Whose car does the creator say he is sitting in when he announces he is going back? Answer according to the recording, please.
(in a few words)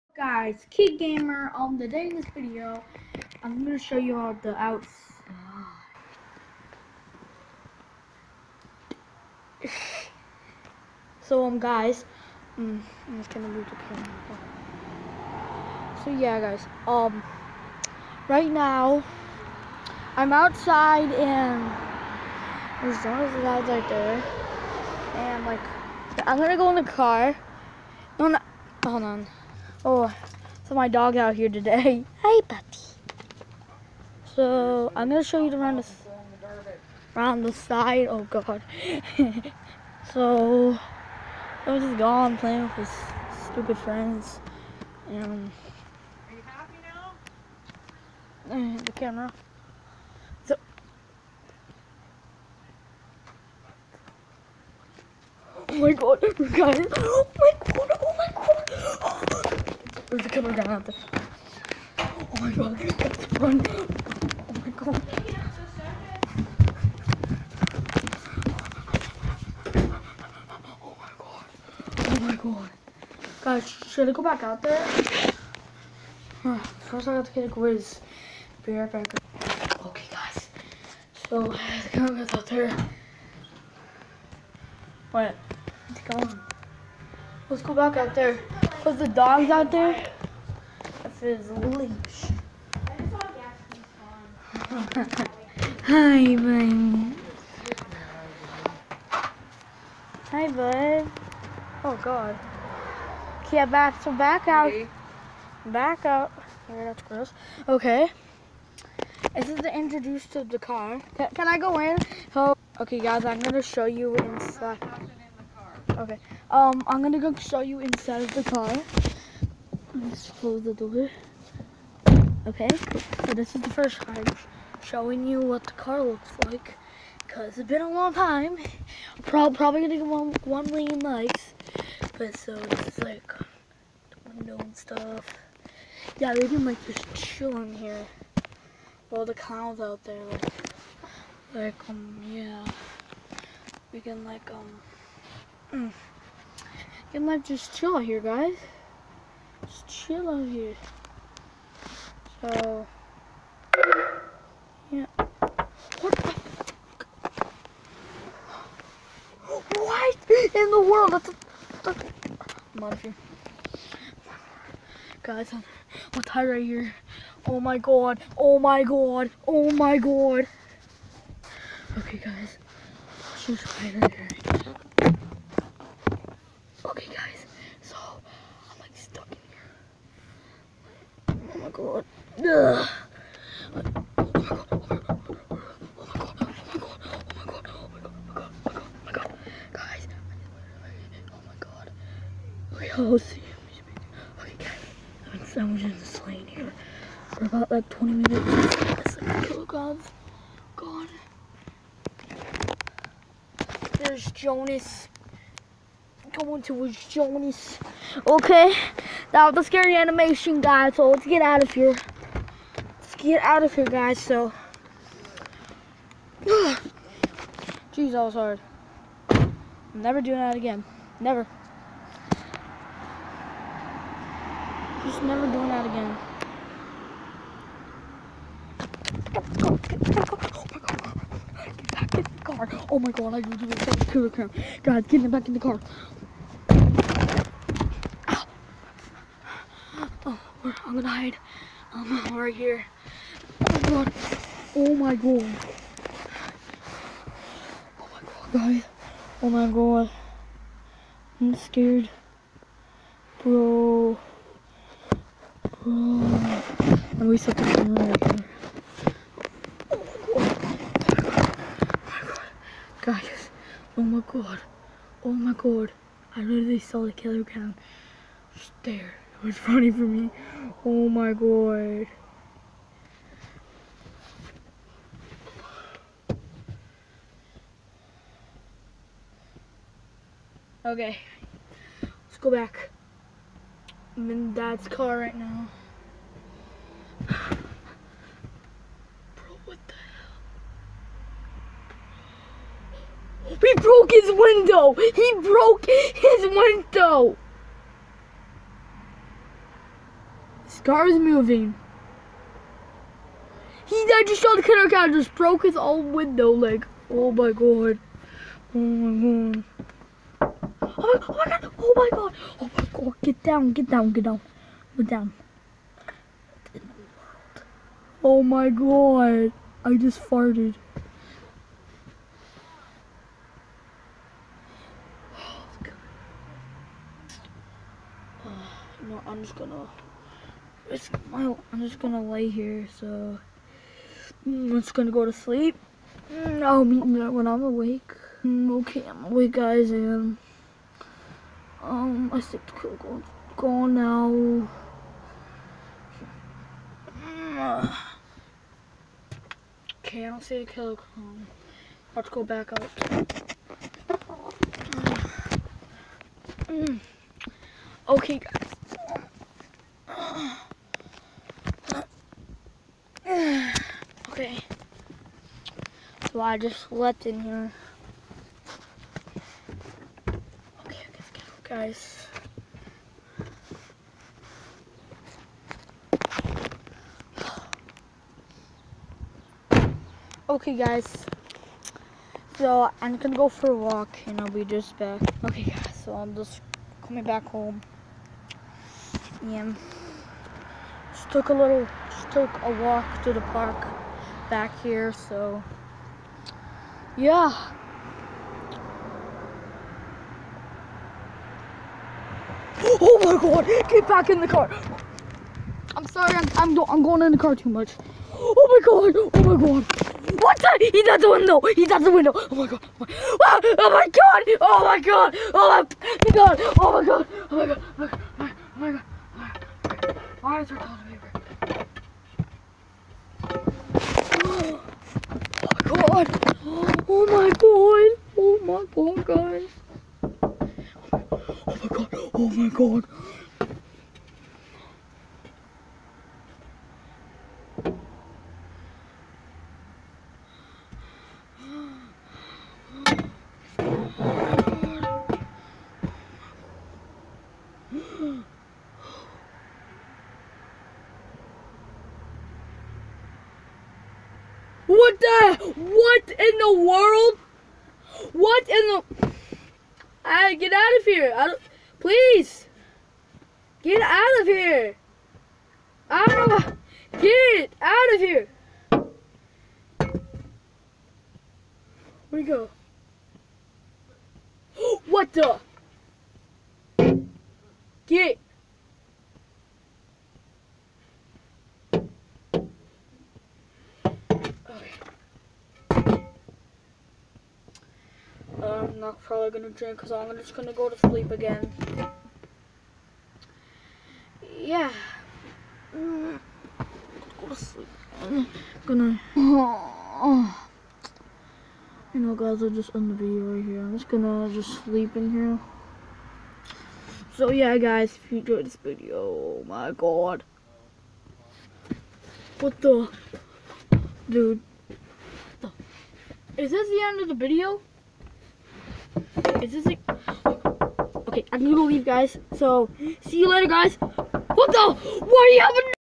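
dad's car.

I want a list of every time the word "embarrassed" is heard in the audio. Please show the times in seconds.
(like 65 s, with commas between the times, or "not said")
not said.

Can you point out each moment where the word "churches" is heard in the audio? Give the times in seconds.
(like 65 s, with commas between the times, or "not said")
not said.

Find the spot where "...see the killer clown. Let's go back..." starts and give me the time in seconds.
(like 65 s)
350 s.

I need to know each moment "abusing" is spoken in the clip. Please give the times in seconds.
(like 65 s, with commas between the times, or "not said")
not said.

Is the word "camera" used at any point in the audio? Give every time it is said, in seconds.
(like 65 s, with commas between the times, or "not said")
13 s, 48 s.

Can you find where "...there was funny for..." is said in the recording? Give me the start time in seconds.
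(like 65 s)
268 s.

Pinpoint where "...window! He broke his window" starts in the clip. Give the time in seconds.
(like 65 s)
294 s.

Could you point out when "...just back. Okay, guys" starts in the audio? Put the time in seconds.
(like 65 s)
384 s.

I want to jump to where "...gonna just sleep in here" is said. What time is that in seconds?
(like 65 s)
504 s.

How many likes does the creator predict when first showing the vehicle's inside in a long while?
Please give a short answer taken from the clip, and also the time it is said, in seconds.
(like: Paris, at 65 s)
1 million, at 130 s.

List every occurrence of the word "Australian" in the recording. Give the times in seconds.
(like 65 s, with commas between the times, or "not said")
not said.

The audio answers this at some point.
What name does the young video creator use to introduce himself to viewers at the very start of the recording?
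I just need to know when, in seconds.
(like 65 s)
0 s.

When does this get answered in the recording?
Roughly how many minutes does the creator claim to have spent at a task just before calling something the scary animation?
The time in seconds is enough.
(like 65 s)
197 s.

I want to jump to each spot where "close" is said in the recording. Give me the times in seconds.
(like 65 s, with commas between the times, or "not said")
120 s.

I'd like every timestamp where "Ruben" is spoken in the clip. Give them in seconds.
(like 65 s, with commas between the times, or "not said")
not said.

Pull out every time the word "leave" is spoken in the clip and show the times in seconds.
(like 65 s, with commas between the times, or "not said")
521 s.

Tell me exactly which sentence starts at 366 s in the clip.
So I just slept in here.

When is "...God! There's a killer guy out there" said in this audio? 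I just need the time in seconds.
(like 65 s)
57 s.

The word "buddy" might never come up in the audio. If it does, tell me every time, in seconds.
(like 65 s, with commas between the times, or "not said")
32 s.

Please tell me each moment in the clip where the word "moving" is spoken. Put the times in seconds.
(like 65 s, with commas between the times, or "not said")
301 s.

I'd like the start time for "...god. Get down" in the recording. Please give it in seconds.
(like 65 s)
312 s.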